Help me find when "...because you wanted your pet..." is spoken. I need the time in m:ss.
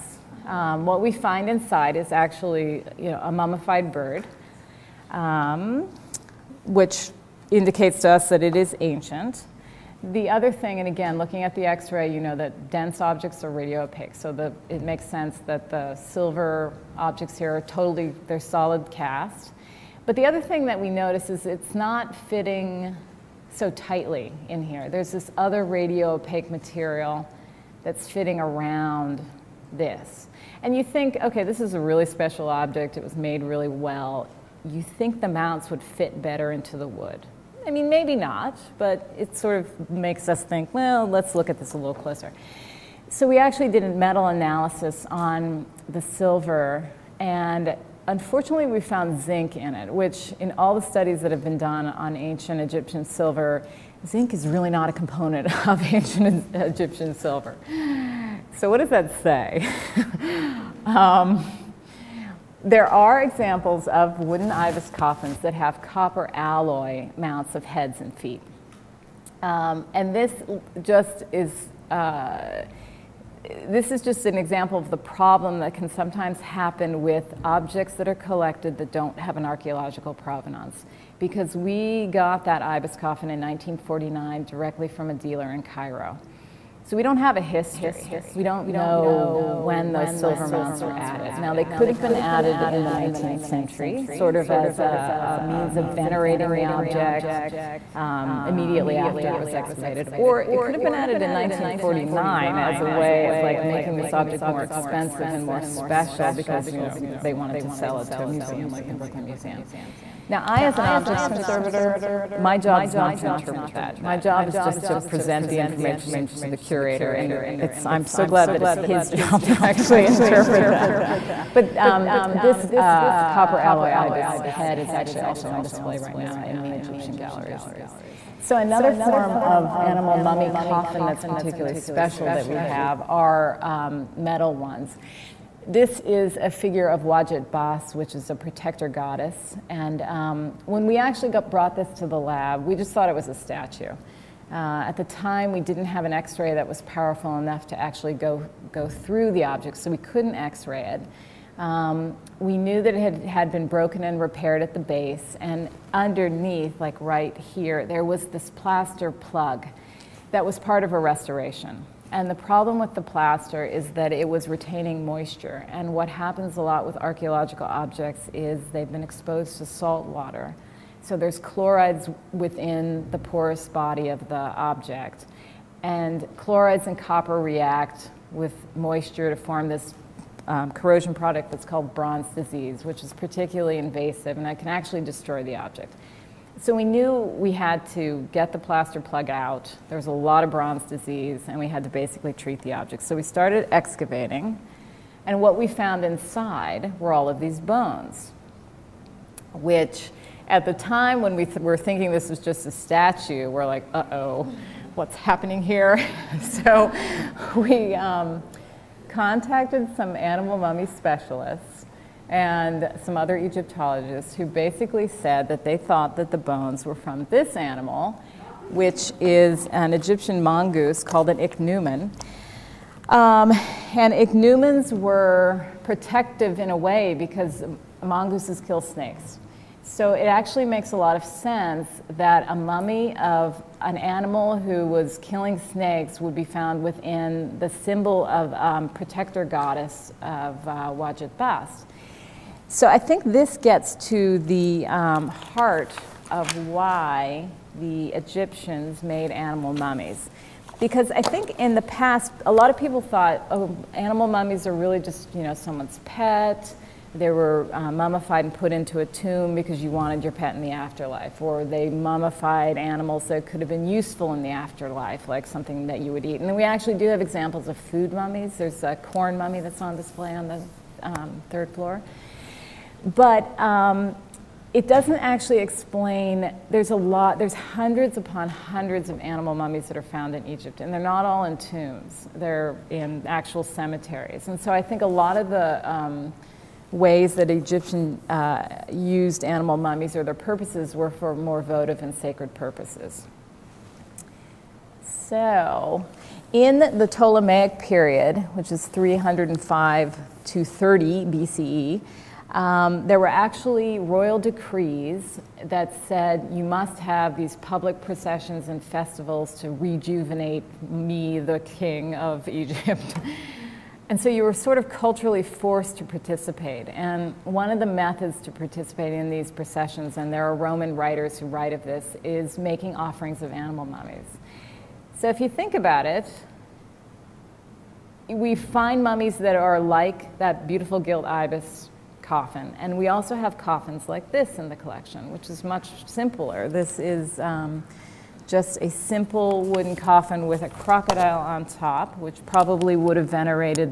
4:19.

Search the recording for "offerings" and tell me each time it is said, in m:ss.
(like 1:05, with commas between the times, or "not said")
5:22.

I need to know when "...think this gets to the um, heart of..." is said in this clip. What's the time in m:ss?
4:02.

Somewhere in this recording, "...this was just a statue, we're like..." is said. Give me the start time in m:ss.
3:22.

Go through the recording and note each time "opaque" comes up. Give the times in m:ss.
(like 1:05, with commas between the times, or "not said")
0:13, 0:26.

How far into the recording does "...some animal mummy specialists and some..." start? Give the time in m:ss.
3:29.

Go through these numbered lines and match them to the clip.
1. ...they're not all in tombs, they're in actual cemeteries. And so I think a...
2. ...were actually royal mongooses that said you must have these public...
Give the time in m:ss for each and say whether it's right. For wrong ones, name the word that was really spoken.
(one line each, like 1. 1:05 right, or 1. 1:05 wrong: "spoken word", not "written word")
1. 4:40 right
2. 5:03 wrong: "decrees", not "mongooses".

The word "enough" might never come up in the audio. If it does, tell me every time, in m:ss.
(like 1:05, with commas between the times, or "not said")
2:27.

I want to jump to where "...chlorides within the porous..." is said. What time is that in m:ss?
2:51.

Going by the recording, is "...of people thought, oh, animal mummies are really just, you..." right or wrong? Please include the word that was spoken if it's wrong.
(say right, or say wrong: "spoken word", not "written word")
right.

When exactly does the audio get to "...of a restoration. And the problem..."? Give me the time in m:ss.
2:40.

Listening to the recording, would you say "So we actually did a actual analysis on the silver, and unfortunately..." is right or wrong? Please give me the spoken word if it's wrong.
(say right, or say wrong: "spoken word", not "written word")
wrong: "metal", not "actual".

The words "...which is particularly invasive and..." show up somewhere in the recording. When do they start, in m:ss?
3:02.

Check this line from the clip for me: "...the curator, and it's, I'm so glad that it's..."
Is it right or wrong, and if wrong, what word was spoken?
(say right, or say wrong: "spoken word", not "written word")
right.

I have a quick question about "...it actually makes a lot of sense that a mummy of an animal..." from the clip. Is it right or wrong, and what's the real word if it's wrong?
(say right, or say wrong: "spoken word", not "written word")
right.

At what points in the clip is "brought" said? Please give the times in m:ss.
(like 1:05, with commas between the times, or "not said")
2:21.